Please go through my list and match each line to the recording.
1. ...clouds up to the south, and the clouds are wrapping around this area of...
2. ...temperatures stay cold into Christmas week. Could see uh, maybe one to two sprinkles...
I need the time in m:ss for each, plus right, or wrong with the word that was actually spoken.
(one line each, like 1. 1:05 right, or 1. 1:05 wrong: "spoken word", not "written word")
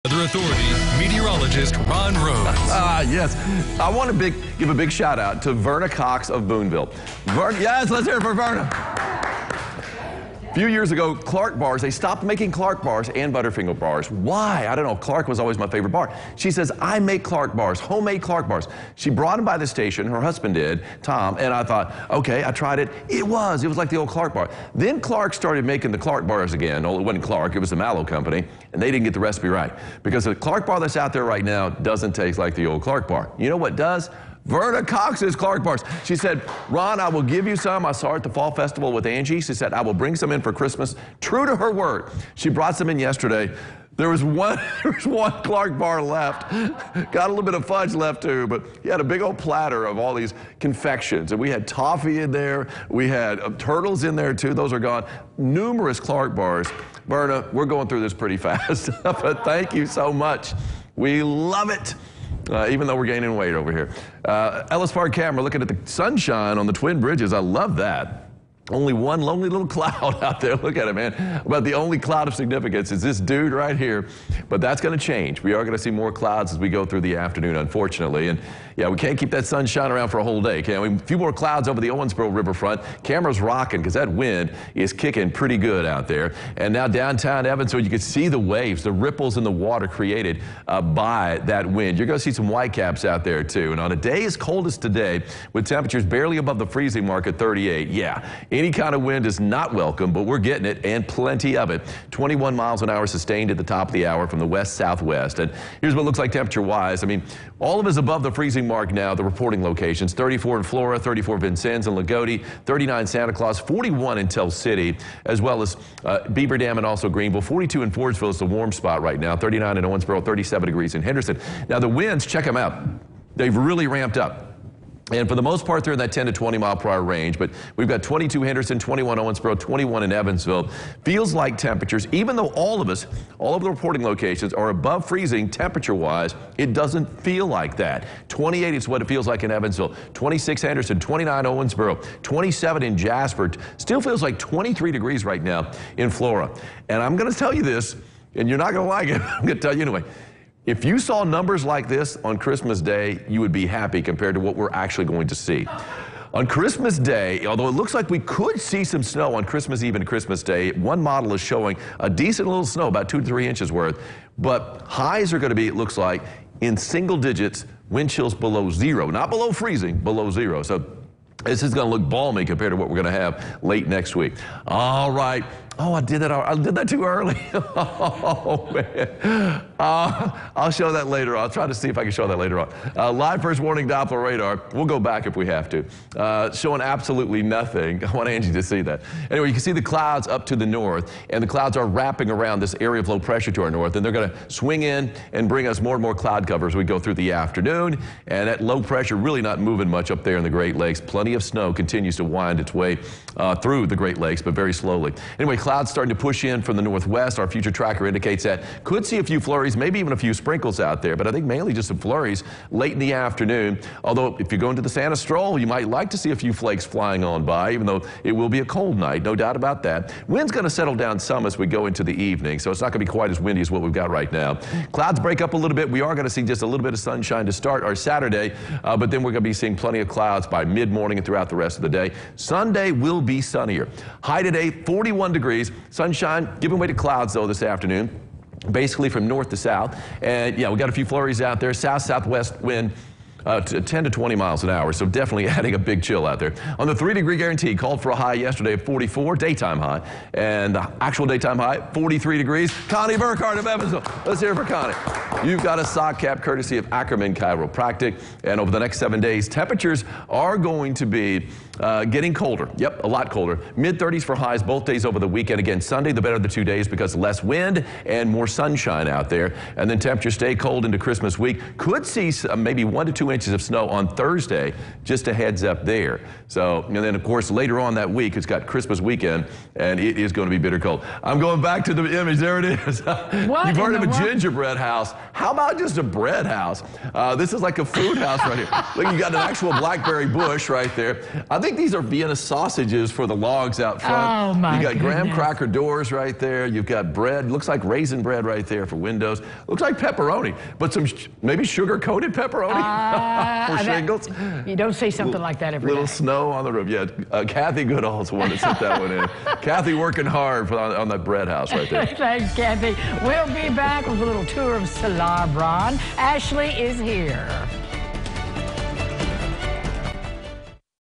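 1. 3:09 wrong: "north", not "south"
2. 4:29 wrong: "inches", not "sprinkles".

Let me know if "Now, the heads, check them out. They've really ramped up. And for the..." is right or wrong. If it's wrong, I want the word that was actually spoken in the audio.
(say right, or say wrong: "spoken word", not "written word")
wrong: "winds", not "heads".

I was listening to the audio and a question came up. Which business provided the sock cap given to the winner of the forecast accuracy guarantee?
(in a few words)
Ackerman Chiropractic.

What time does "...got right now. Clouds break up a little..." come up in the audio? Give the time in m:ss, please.
3:43.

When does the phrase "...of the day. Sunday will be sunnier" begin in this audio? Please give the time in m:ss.
3:51.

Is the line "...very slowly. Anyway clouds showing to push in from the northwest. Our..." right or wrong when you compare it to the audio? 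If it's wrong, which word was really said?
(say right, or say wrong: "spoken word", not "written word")
wrong: "starting", not "showing".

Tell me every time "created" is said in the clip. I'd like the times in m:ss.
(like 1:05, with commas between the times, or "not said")
1:29.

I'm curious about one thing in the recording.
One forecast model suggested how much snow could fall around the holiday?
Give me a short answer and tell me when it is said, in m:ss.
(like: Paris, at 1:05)
2 to 3 inches, at 2:43.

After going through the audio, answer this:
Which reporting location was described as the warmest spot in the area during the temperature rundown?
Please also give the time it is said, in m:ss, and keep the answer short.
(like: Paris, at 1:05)
Fordsville, at 1:57.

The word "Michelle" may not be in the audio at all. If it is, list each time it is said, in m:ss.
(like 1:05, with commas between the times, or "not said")
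not said.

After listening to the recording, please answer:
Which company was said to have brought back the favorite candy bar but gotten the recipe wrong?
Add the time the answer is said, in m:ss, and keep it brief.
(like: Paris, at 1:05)
Mallow Company, at 0:27.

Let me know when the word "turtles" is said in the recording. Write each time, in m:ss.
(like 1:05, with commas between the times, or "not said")
0:53.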